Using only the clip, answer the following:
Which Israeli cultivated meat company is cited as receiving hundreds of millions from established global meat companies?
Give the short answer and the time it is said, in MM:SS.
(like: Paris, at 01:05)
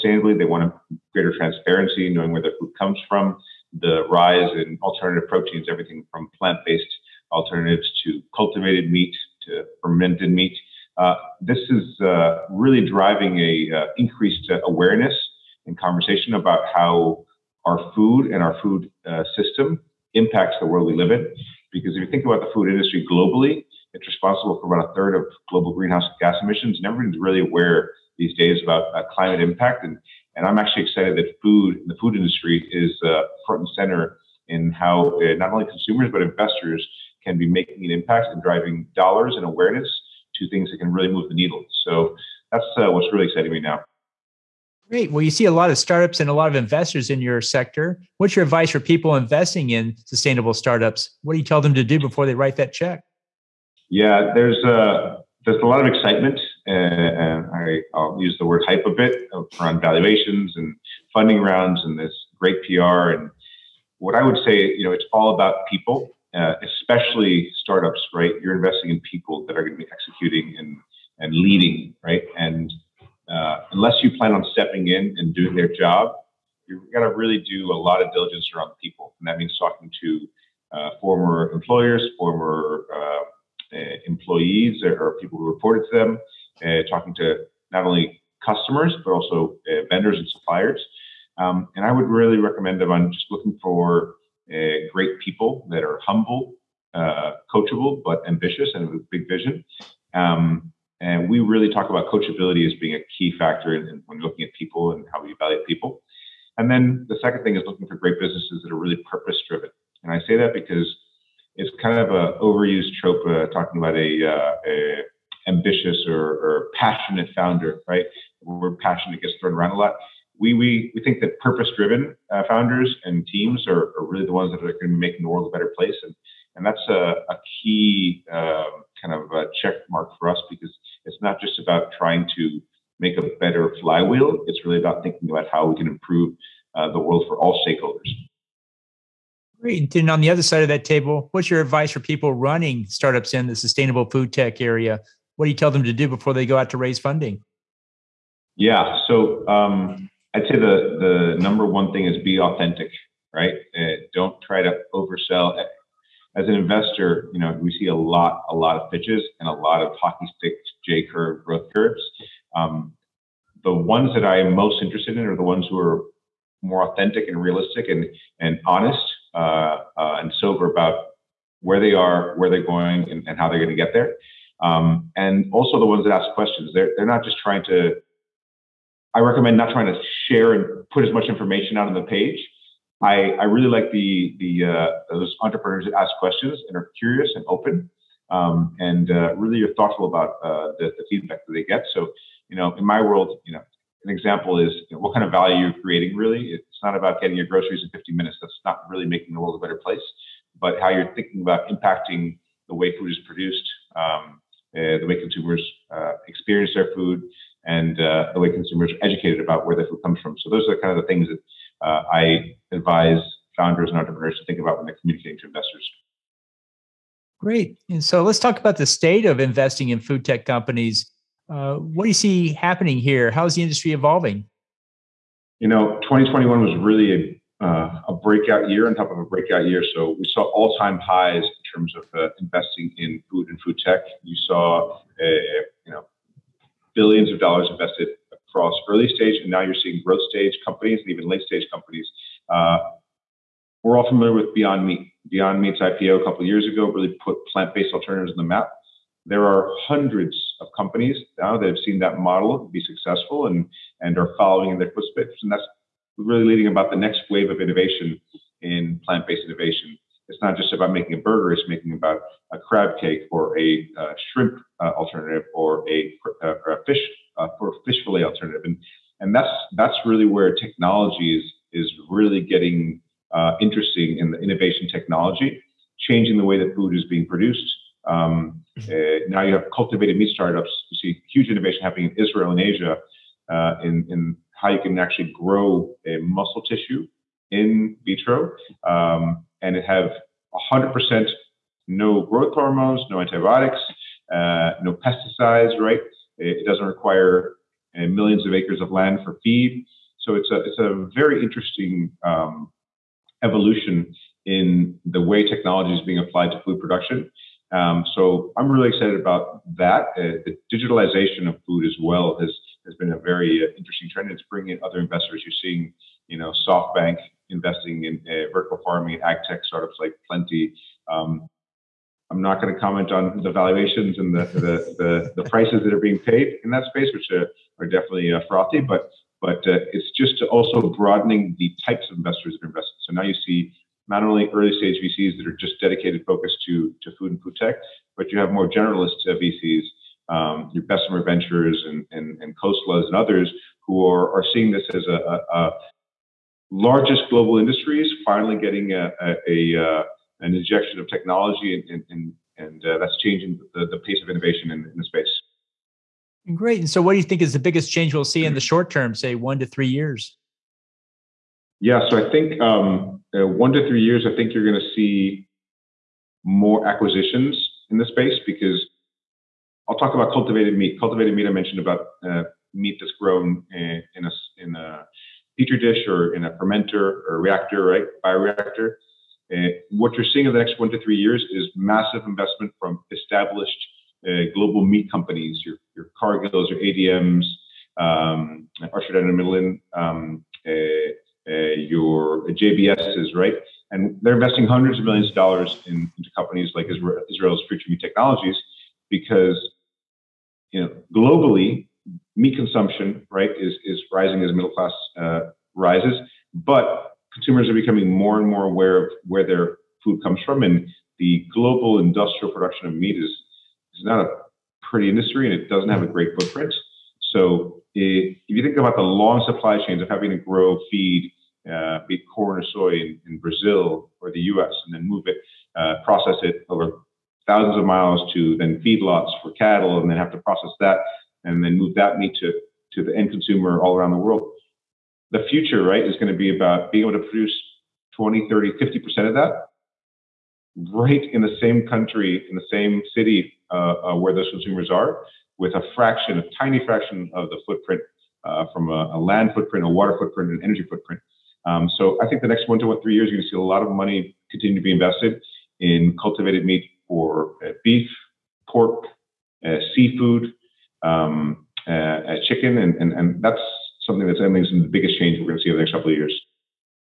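Future Meat Technologies, at 06:37.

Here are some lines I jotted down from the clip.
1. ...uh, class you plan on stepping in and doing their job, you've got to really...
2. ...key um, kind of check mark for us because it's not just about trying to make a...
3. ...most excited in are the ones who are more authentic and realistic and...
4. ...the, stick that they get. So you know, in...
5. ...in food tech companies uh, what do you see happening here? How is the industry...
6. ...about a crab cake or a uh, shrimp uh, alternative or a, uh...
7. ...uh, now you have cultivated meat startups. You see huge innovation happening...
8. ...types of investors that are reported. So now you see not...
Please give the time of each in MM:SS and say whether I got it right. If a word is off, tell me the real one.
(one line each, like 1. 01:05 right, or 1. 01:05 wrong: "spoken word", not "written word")
1. 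01:13 wrong: "unless", not "class"
2. 02:07 right
3. 02:44 wrong: "interested", not "excited"
4. 03:10 wrong: "feedback", not "stick"
5. 03:39 right
6. 04:21 right
7. 04:38 right
8. 05:31 wrong: "invested", not "reported".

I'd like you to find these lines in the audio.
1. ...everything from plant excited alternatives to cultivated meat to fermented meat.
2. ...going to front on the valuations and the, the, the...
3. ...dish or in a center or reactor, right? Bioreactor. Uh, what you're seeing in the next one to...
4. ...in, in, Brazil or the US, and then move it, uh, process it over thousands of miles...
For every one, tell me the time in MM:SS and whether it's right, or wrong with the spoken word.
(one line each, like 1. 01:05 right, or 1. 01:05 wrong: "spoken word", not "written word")
1. 00:05 wrong: "based", not "excited"
2. 05:22 wrong: "comment", not "front"
3. 06:15 wrong: "fermenter", not "center"
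4. 07:02 right.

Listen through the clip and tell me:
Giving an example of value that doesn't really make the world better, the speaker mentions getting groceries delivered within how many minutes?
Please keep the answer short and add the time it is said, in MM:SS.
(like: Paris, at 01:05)
50 minutes, at 03:17.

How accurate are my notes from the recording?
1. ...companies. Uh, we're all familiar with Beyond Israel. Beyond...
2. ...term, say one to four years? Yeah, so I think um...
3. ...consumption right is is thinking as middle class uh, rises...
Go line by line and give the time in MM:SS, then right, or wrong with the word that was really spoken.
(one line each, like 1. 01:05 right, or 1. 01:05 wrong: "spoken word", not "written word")
1. 04:01 wrong: "Meat", not "Israel"
2. 05:58 wrong: "three", not "four"
3. 06:42 wrong: "rising", not "thinking".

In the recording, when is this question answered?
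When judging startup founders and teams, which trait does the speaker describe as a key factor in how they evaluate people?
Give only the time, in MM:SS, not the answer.
01:42.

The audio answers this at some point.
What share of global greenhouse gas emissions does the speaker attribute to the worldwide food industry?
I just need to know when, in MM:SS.
00:24.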